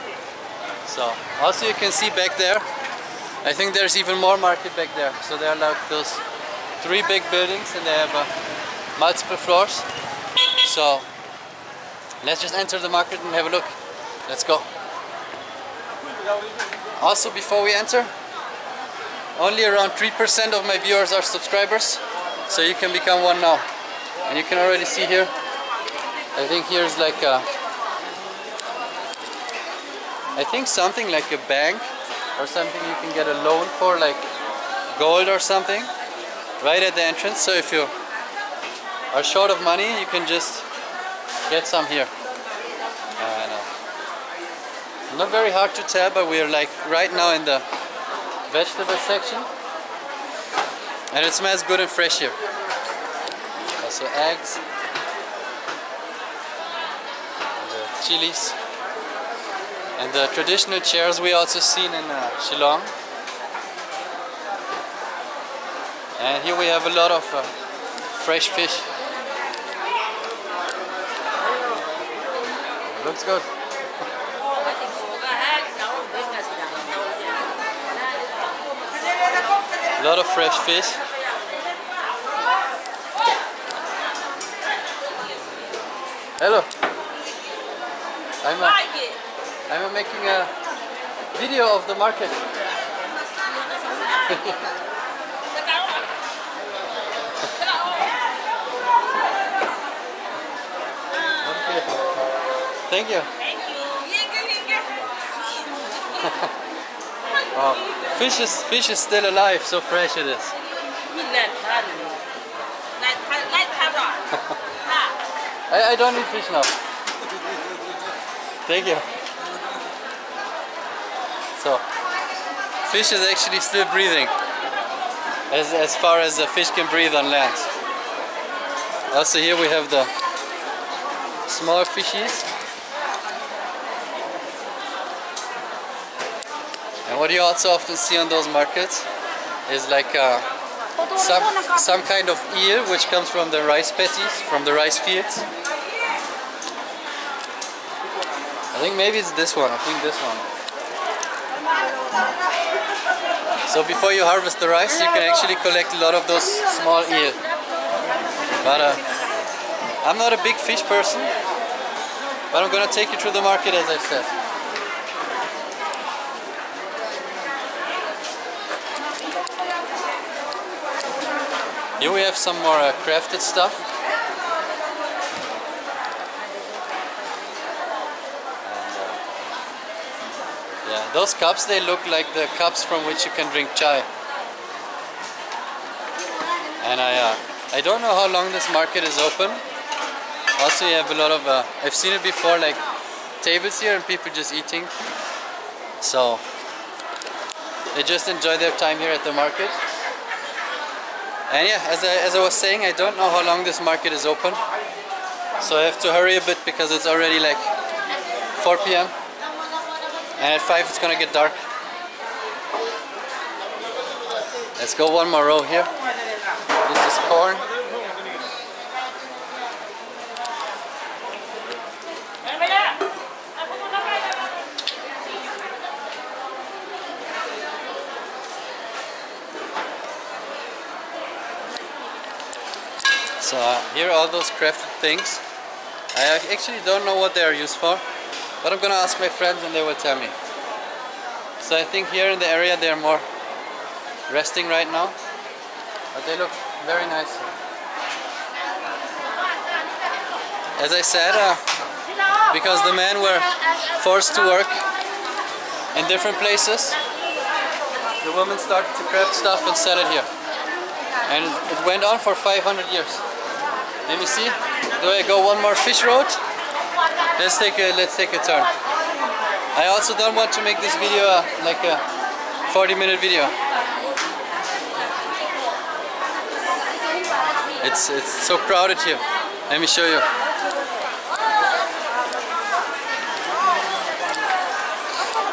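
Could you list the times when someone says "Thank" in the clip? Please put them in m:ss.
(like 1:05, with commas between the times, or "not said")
1:43, 1:58.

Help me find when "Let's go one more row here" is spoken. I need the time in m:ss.
3:34.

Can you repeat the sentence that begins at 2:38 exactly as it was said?
But uh, I'm not a big fish person, but I'm gonna take you through the market as I said.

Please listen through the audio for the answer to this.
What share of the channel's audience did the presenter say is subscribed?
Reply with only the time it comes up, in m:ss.
0:19.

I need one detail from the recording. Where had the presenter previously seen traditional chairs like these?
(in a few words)
Shillong.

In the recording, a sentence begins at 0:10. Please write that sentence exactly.
So Let's just enter the market and have a look.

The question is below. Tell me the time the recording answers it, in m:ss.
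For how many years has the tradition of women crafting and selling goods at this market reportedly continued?
4:22.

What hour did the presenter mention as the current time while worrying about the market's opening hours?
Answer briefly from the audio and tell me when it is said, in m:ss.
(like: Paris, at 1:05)
4 p.m., at 3:28.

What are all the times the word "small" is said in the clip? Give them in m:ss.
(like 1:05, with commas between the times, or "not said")
2:11, 2:36.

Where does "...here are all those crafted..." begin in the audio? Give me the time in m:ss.
3:53.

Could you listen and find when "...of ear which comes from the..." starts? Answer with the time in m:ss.
2:22.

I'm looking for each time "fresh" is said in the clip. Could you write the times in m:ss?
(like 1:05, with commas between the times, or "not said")
0:51, 1:08, 1:20, 1:49.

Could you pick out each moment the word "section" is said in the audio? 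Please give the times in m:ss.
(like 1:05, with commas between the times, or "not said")
0:49.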